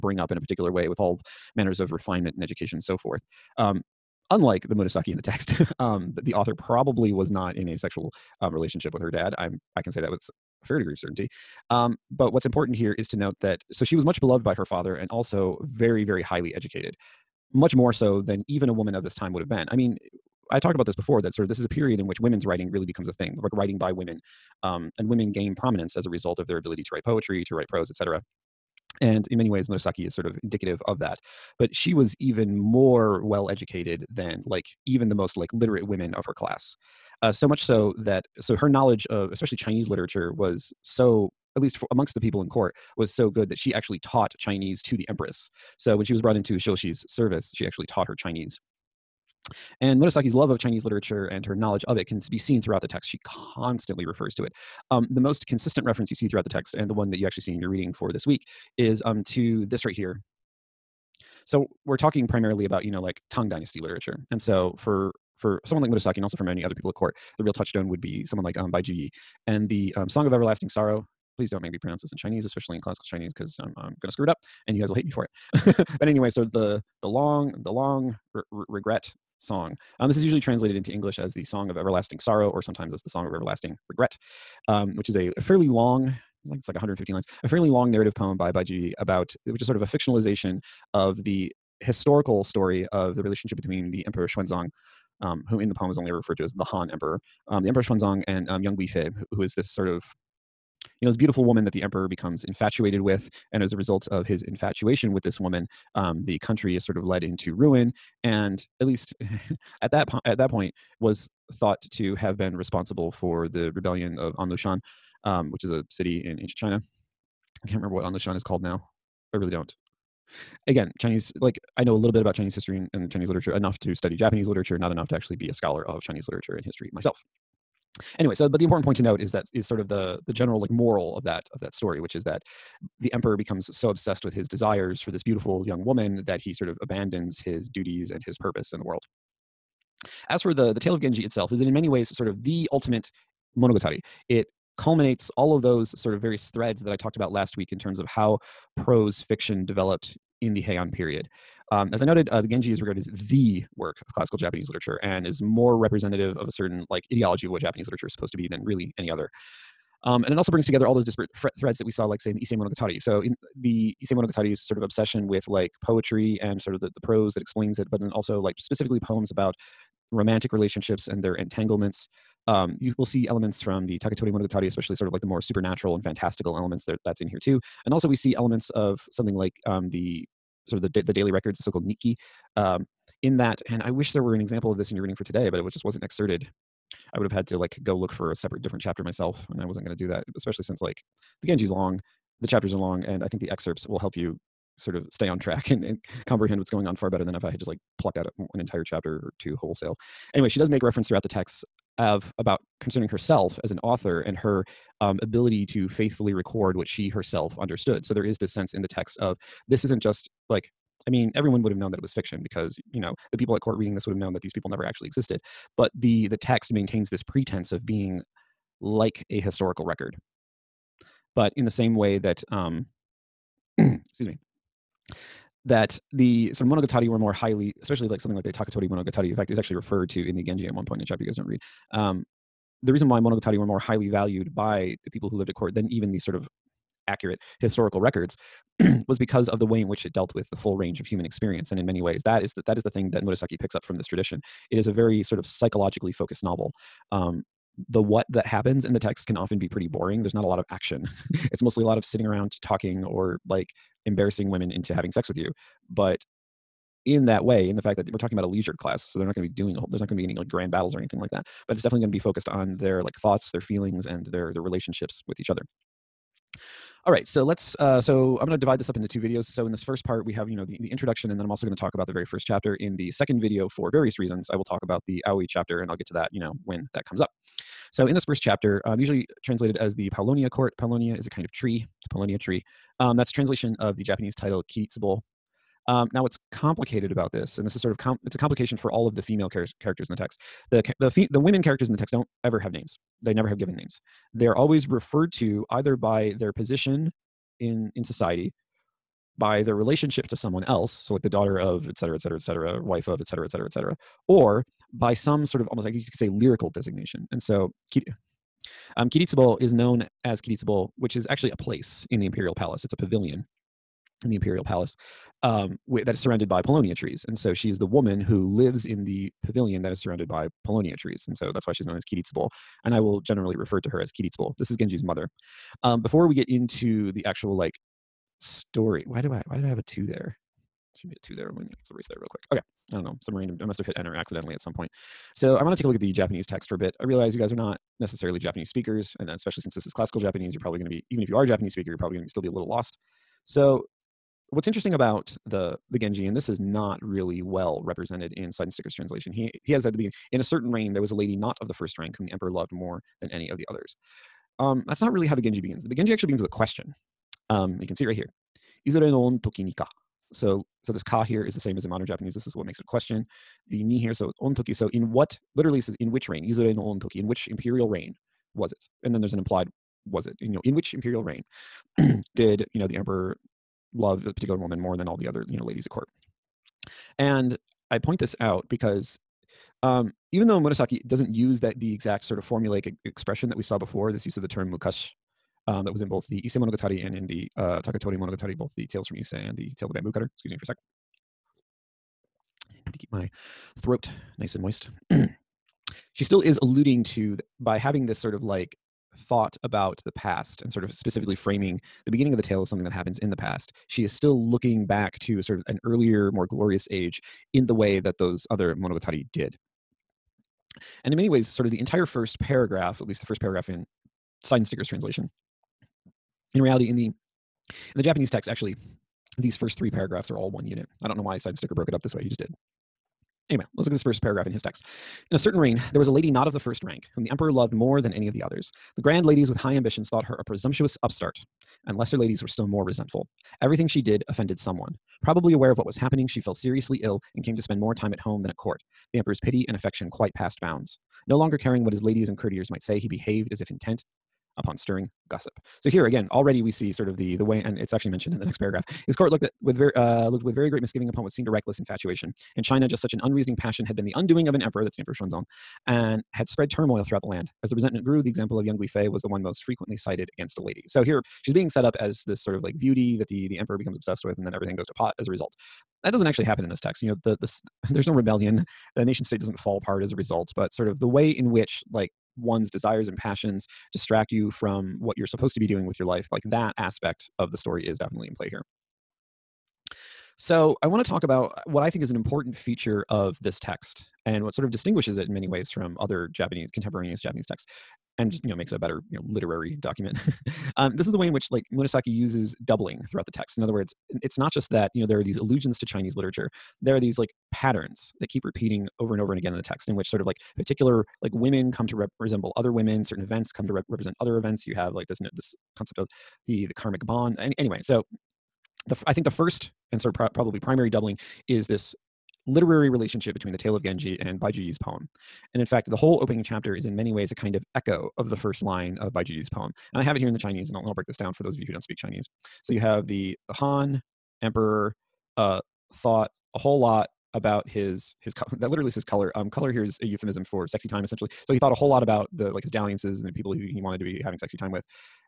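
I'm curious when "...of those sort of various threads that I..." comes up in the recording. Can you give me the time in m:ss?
2:25.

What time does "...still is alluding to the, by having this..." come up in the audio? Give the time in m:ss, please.
6:36.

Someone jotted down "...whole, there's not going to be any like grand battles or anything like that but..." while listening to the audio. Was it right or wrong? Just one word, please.
right.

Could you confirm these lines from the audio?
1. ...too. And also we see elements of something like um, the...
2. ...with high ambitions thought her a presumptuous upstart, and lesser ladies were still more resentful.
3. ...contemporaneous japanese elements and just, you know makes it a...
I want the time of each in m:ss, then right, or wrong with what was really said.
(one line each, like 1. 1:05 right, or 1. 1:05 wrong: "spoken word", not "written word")
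1. 2:57 right
2. 7:09 right
3. 8:06 wrong: "texts", not "elements".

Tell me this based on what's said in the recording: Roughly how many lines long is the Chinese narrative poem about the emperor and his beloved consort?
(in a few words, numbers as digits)
115.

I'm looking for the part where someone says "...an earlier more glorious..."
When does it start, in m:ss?
6:45.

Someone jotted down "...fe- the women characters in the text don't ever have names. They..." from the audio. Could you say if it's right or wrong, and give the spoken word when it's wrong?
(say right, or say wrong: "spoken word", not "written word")
right.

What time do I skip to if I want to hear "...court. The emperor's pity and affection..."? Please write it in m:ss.
7:18.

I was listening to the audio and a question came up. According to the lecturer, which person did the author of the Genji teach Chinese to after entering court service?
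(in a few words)
the empress.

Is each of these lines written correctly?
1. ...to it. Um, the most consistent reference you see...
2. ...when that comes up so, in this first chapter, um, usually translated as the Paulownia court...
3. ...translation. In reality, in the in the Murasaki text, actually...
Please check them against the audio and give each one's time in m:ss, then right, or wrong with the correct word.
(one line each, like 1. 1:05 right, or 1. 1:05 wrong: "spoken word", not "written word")
1. 0:54 right
2. 4:36 right
3. 6:54 wrong: "Japanese", not "Murasaki".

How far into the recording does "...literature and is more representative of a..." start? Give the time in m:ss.
2:34.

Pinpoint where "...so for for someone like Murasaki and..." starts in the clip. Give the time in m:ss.
1:04.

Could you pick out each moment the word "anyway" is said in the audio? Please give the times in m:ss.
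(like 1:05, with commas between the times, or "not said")
1:16, 2:08, 3:20, 7:03, 8:27.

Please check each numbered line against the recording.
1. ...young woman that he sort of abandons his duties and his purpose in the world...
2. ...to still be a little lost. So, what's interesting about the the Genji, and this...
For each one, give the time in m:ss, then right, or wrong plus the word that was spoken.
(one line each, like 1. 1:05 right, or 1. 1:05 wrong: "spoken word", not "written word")
1. 2:15 right
2. 5:42 right.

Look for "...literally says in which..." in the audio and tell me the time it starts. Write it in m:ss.
6:05.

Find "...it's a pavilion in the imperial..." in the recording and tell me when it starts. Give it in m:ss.
5:12.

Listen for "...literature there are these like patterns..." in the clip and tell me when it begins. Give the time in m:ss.
8:16.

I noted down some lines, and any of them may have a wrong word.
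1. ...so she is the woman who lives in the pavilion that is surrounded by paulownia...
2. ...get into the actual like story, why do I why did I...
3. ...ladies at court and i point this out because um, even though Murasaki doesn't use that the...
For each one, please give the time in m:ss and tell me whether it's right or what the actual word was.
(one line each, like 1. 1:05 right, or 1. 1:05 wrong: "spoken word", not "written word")
1. 5:17 right
2. 5:26 right
3. 6:15 right.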